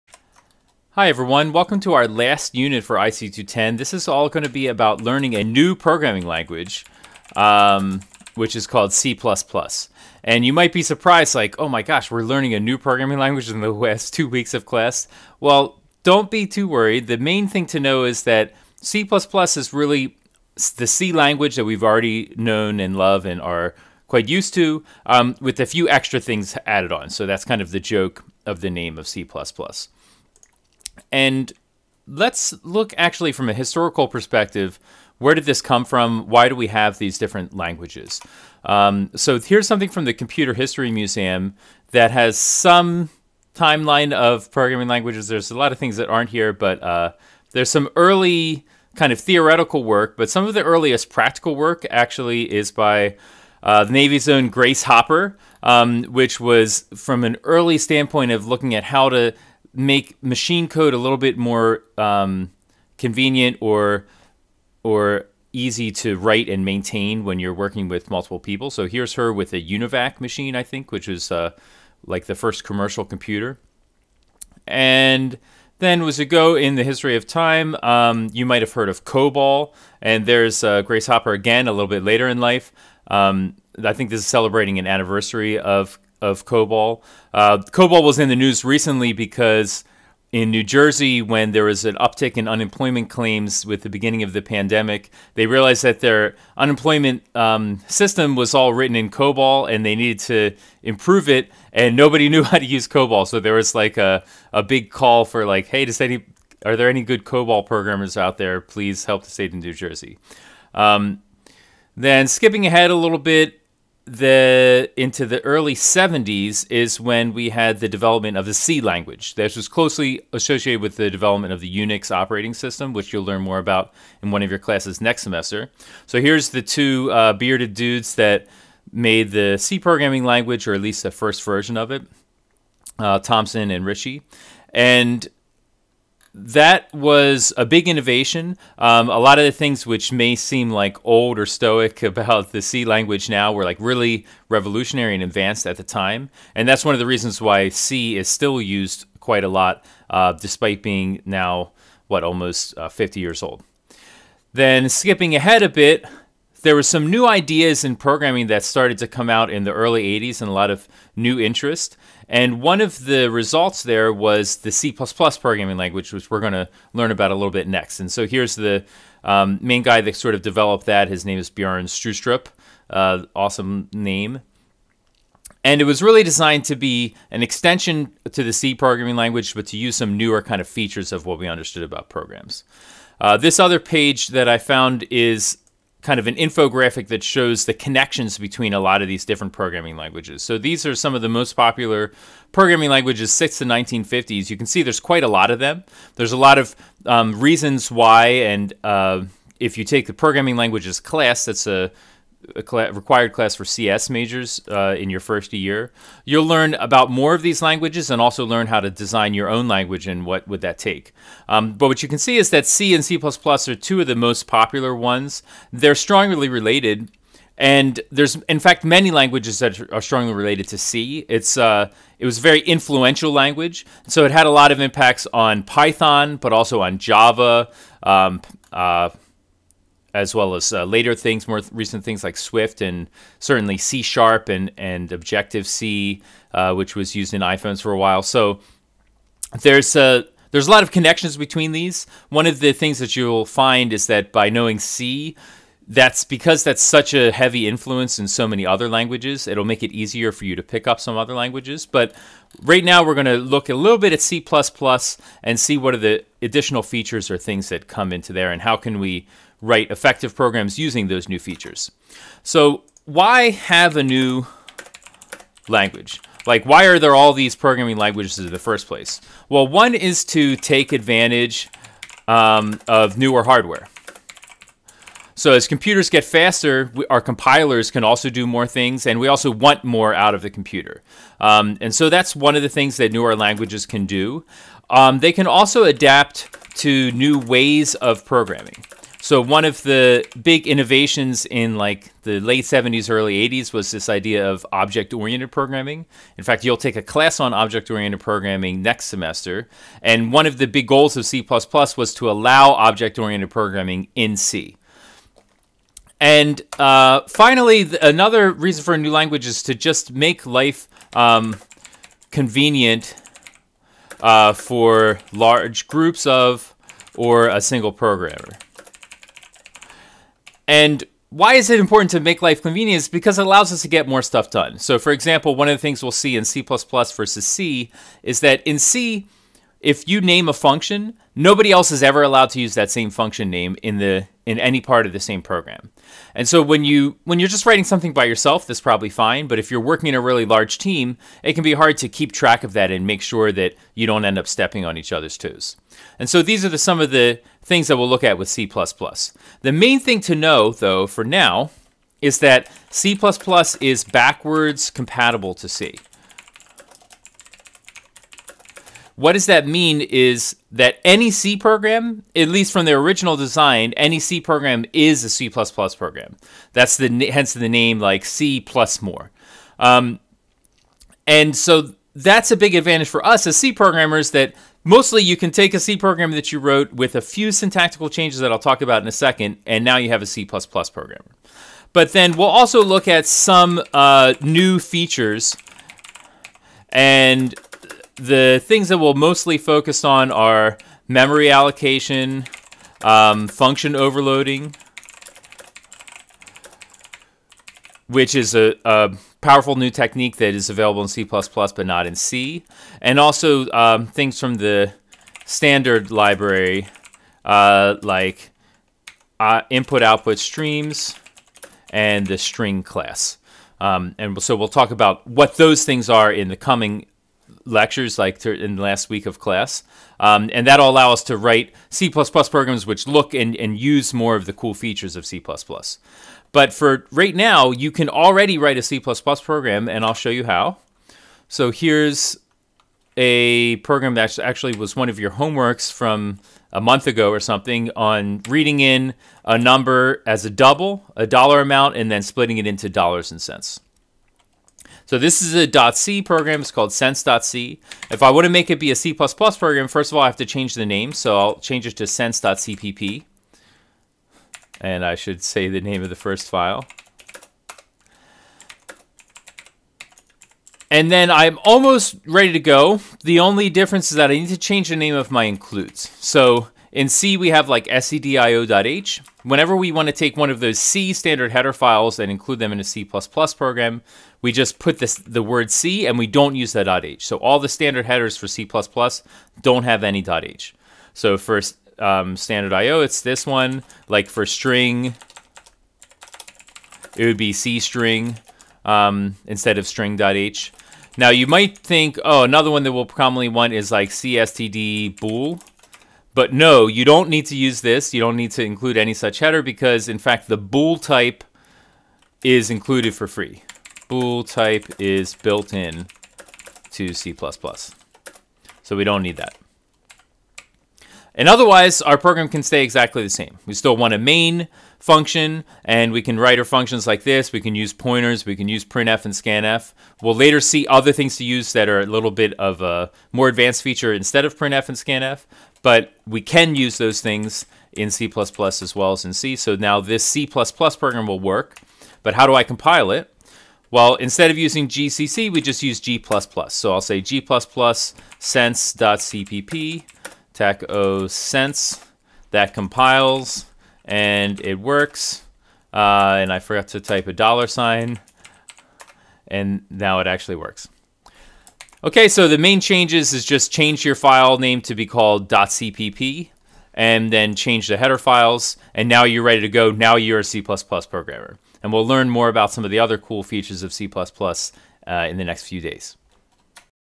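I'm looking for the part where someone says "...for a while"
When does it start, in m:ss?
3:57.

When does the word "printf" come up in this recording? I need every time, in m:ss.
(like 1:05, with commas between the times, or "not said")
8:38, 8:44.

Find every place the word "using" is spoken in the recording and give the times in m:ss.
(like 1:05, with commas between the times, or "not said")
4:20, 8:54.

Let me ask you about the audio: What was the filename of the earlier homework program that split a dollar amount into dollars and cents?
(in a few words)
cents.c.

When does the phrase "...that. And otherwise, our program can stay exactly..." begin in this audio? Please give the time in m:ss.
8:29.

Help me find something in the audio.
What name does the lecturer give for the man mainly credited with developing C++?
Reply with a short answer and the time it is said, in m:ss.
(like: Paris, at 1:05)
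Bjorn Stroustrup, at 2:51.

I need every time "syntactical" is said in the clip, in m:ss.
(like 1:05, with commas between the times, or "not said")
6:17.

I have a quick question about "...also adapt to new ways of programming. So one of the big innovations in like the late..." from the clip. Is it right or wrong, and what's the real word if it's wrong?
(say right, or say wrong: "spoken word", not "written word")
right.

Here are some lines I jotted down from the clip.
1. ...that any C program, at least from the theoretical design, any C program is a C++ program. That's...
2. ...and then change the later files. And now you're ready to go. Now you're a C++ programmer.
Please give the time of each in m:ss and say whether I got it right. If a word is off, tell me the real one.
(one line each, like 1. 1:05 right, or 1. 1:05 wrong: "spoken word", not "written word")
1. 6:00 wrong: "original", not "theoretical"
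2. 9:16 wrong: "header", not "later".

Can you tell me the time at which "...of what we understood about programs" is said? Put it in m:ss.
3:01.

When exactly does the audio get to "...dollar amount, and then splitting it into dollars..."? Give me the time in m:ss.
7:21.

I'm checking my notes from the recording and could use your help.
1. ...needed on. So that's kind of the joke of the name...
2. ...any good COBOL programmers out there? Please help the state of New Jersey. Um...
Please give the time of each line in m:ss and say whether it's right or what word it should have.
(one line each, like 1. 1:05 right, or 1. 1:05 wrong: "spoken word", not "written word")
1. 0:26 wrong: "added", not "needed"
2. 1:46 right.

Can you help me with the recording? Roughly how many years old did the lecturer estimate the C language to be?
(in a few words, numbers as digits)
50.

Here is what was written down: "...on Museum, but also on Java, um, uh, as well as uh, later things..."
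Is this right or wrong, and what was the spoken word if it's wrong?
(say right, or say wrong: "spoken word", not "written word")
wrong: "Python", not "Museum".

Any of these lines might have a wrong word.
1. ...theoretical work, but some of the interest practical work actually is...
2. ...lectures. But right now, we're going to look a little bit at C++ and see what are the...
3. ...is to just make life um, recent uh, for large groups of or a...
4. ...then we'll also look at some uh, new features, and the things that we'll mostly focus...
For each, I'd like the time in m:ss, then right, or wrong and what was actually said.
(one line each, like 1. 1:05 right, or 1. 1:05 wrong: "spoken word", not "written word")
1. 0:49 wrong: "earliest", not "interest"
2. 4:11 wrong: "languages", not "lectures"
3. 5:09 wrong: "convenient", not "recent"
4. 6:22 right.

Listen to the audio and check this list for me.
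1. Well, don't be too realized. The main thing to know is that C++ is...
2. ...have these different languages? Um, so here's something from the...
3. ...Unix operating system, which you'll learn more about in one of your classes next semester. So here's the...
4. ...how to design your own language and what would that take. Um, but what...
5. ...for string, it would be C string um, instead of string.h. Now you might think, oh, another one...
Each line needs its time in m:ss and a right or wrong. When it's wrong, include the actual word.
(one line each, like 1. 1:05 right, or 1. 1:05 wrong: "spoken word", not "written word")
1. 0:15 wrong: "worried", not "realized"
2. 0:36 right
3. 2:01 right
4. 3:28 right
5. 8:04 right.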